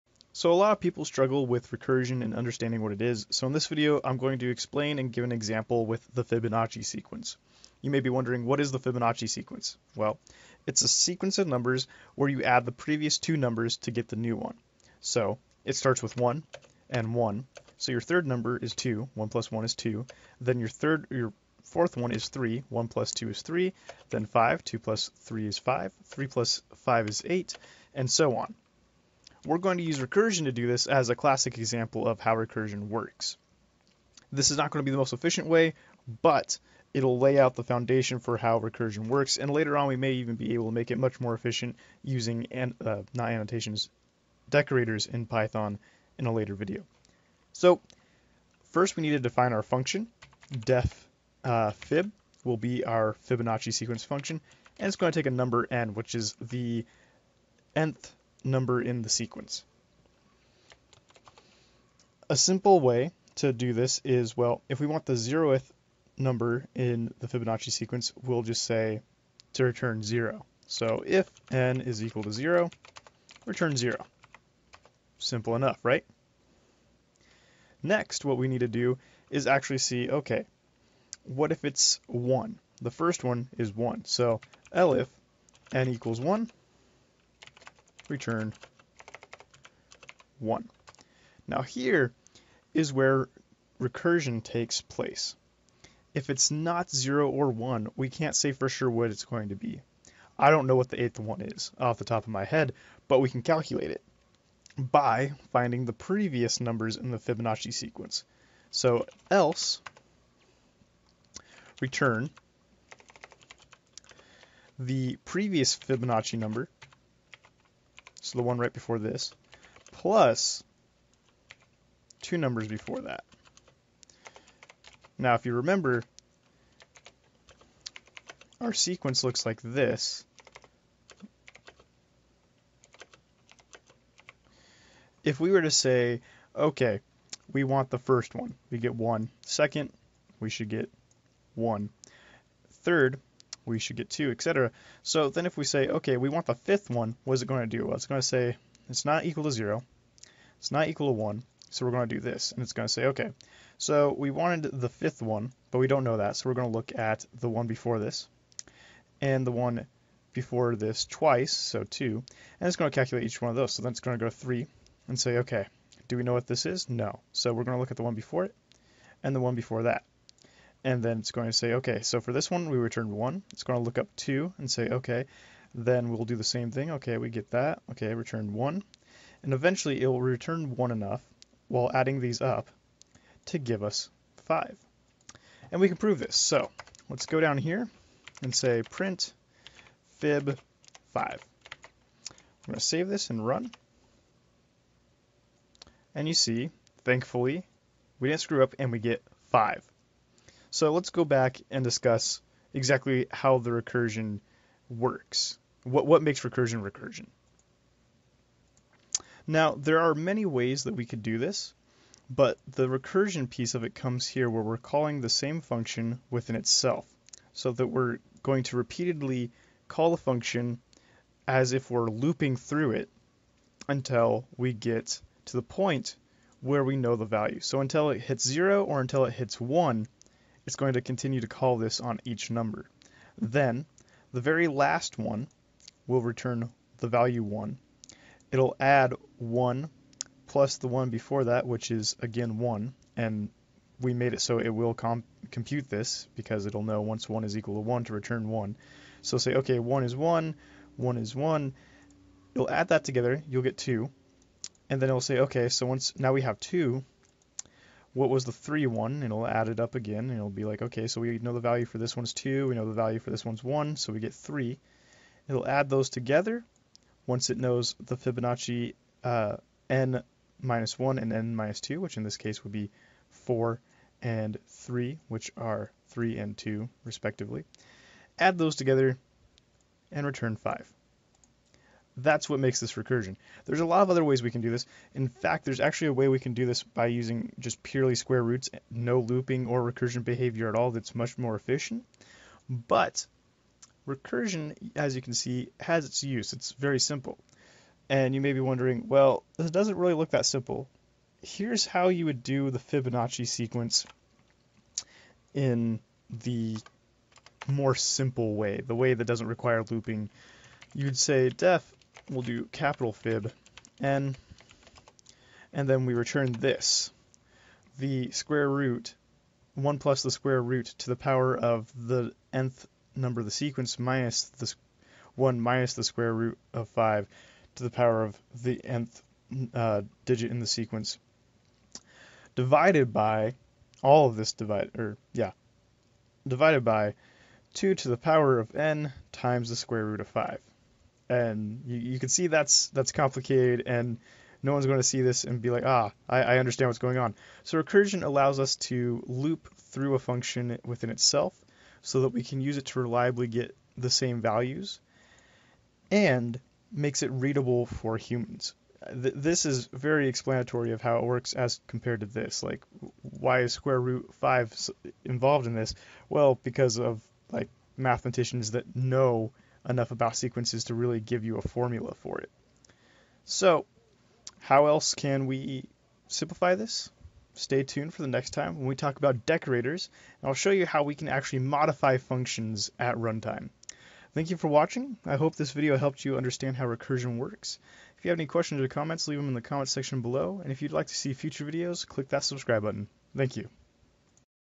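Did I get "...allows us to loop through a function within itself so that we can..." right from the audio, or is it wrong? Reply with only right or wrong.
right.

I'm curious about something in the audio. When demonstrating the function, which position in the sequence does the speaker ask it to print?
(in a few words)
5.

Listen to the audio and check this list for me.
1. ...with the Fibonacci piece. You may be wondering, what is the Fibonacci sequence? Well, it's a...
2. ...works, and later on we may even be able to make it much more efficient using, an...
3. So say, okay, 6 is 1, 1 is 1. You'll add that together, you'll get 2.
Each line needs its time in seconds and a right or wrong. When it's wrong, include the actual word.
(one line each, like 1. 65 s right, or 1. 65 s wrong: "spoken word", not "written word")
1. 5 s wrong: "sequence", not "piece"
2. 39 s right
3. 249 s wrong: "1", not "6".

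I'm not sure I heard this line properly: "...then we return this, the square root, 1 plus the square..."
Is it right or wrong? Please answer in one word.
right.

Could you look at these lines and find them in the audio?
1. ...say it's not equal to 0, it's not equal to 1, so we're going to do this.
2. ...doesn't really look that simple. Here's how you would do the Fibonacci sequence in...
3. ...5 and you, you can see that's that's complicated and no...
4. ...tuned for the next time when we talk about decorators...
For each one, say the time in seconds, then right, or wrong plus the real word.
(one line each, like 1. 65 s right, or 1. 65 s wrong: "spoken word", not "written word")
1. 148 s right
2. 299 s right
3. 340 s right
4. 377 s right.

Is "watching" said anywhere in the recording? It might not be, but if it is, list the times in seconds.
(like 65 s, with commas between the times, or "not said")
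384 s.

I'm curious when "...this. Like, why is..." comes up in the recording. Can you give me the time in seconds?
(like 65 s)
362 s.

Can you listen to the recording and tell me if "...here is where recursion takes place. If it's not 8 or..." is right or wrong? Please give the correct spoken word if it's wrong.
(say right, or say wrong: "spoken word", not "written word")
wrong: "0", not "8".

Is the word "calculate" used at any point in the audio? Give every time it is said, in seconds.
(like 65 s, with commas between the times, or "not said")
103 s, 162 s.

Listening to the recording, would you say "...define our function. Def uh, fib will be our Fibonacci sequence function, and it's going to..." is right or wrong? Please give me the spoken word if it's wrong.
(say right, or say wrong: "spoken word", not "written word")
right.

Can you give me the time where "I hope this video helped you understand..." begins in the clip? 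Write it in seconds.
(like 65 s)
385 s.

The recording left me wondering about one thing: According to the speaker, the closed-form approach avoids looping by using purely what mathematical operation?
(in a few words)
square roots.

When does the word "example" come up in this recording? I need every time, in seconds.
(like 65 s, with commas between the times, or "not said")
5 s, 31 s.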